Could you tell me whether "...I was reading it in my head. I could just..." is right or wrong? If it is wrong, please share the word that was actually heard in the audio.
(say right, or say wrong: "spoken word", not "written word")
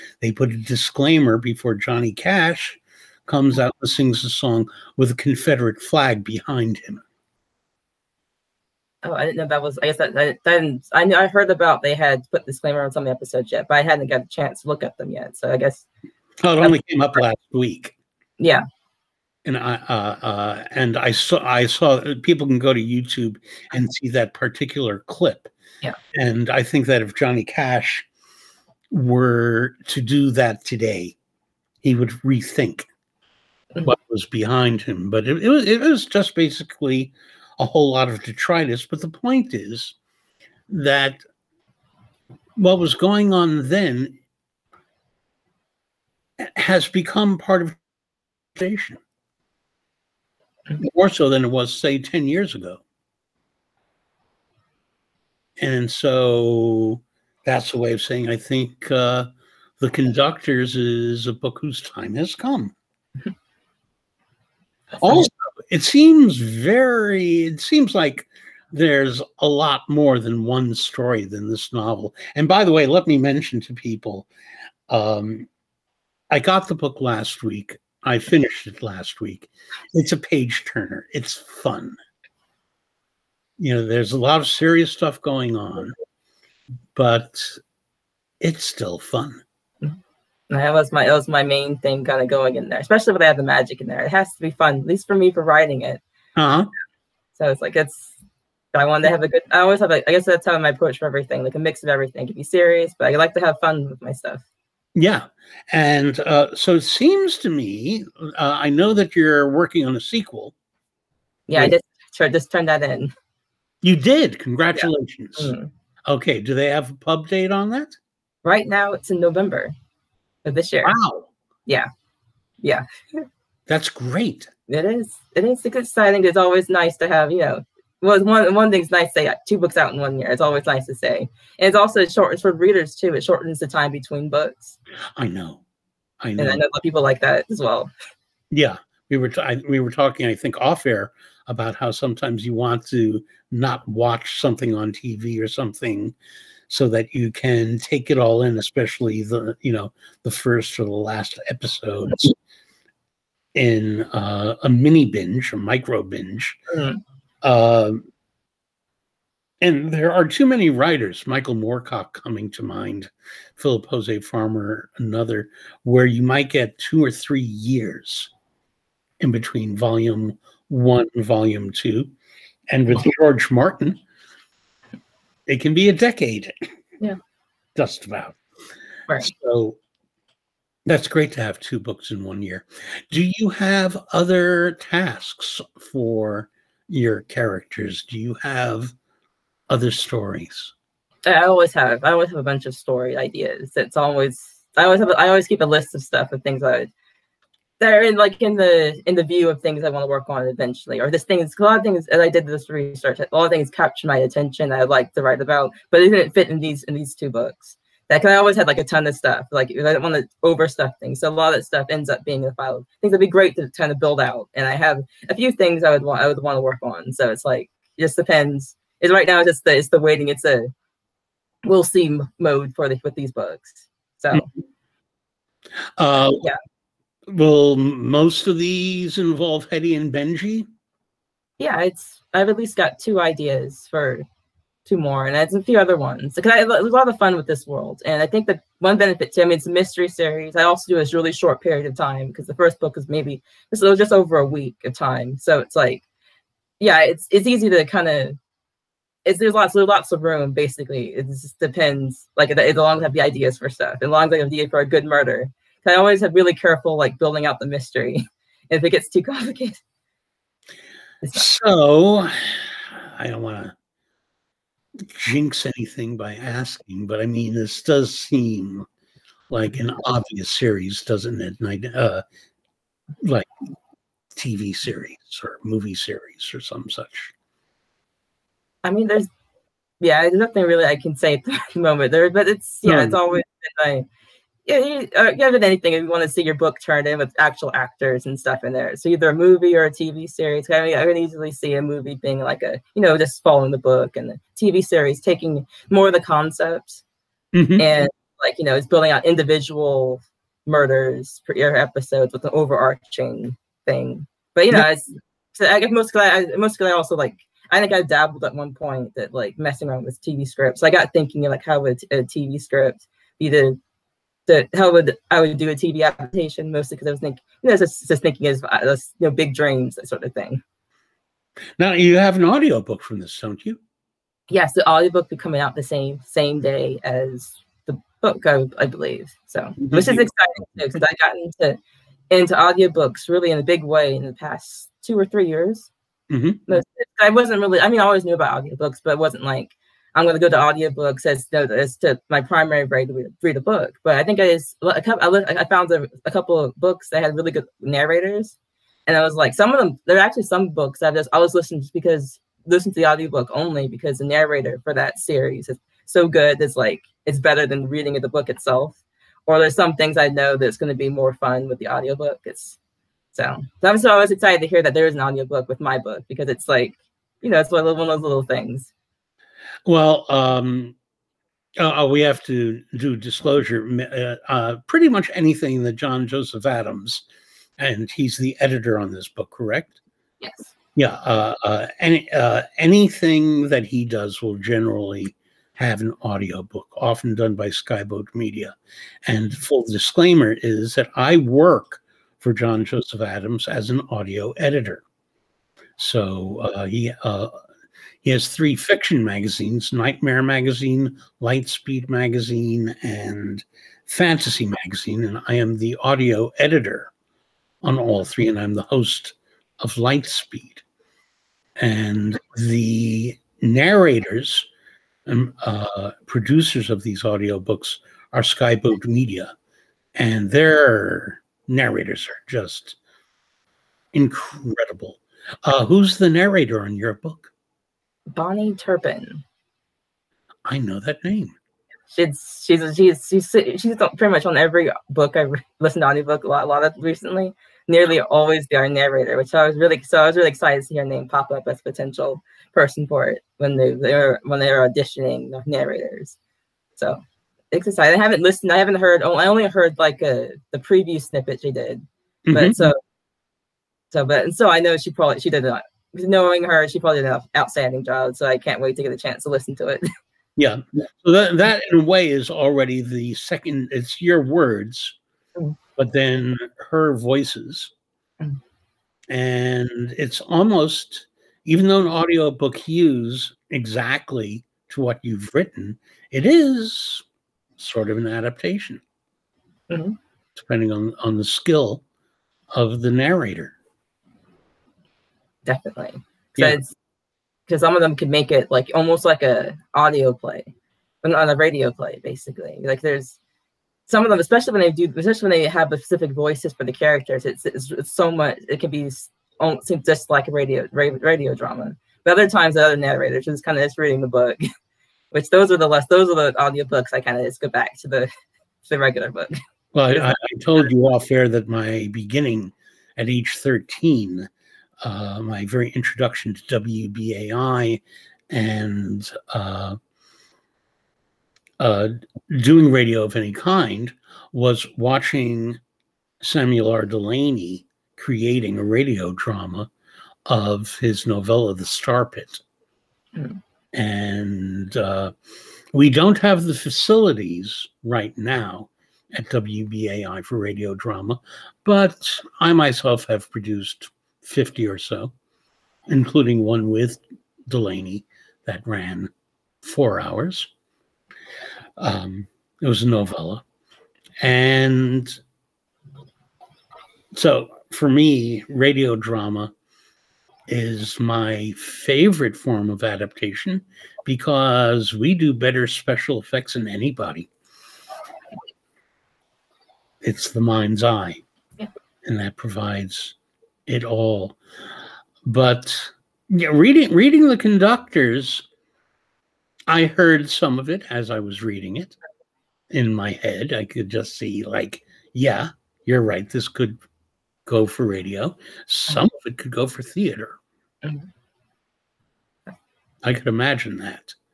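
right.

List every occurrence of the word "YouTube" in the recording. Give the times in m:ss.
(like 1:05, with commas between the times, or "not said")
0:22.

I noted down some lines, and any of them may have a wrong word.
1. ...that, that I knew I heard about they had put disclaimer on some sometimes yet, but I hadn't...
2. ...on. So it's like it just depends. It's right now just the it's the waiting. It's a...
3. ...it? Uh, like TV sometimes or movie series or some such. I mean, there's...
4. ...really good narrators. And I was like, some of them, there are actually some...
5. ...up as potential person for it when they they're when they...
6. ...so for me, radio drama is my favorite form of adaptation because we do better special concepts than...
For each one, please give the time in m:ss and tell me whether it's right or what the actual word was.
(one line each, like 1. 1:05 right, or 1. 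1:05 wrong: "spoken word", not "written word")
1. 0:10 wrong: "episodes", not "sometimes"
2. 3:36 right
3. 4:31 wrong: "series", not "sometimes"
4. 5:47 right
5. 7:21 right
6. 9:17 wrong: "effects", not "concepts".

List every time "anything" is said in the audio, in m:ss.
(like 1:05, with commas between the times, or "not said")
4:25, 4:45, 6:15, 6:22.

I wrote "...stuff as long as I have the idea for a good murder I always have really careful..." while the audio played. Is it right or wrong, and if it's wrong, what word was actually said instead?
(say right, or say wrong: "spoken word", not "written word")
right.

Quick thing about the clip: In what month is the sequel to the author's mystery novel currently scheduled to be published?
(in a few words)
November.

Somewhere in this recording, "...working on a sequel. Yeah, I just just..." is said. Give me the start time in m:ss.
1:49.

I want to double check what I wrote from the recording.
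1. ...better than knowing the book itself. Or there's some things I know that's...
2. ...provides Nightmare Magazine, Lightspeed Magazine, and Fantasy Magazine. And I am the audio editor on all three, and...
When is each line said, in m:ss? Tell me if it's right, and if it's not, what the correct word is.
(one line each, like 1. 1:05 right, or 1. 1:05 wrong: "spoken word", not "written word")
1. 5:57 wrong: "reading", not "knowing"
2. 6:39 wrong: "magazines", not "provides".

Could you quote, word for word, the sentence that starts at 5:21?
Now you have an audiobook from this, don't you?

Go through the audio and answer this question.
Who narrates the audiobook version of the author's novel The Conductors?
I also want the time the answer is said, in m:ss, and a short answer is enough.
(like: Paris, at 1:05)
Bahni Turpin, at 7:08.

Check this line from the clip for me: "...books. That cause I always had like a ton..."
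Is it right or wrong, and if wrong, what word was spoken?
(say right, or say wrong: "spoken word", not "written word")
right.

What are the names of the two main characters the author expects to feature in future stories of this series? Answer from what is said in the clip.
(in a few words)
Hetty and Benji.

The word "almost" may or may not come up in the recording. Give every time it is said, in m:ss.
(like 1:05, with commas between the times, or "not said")
7:50, 8:08.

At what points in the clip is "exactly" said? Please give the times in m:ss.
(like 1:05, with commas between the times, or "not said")
7:53.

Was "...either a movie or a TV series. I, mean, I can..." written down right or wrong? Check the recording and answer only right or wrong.
right.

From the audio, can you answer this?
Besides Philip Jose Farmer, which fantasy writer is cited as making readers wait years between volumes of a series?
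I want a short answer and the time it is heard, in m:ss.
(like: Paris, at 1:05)
Michael Moorcock, at 2:41.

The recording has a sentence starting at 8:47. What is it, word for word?
Delany creating a radio drama of his novella, The Star Pit.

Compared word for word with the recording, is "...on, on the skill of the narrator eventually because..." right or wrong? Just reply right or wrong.
wrong.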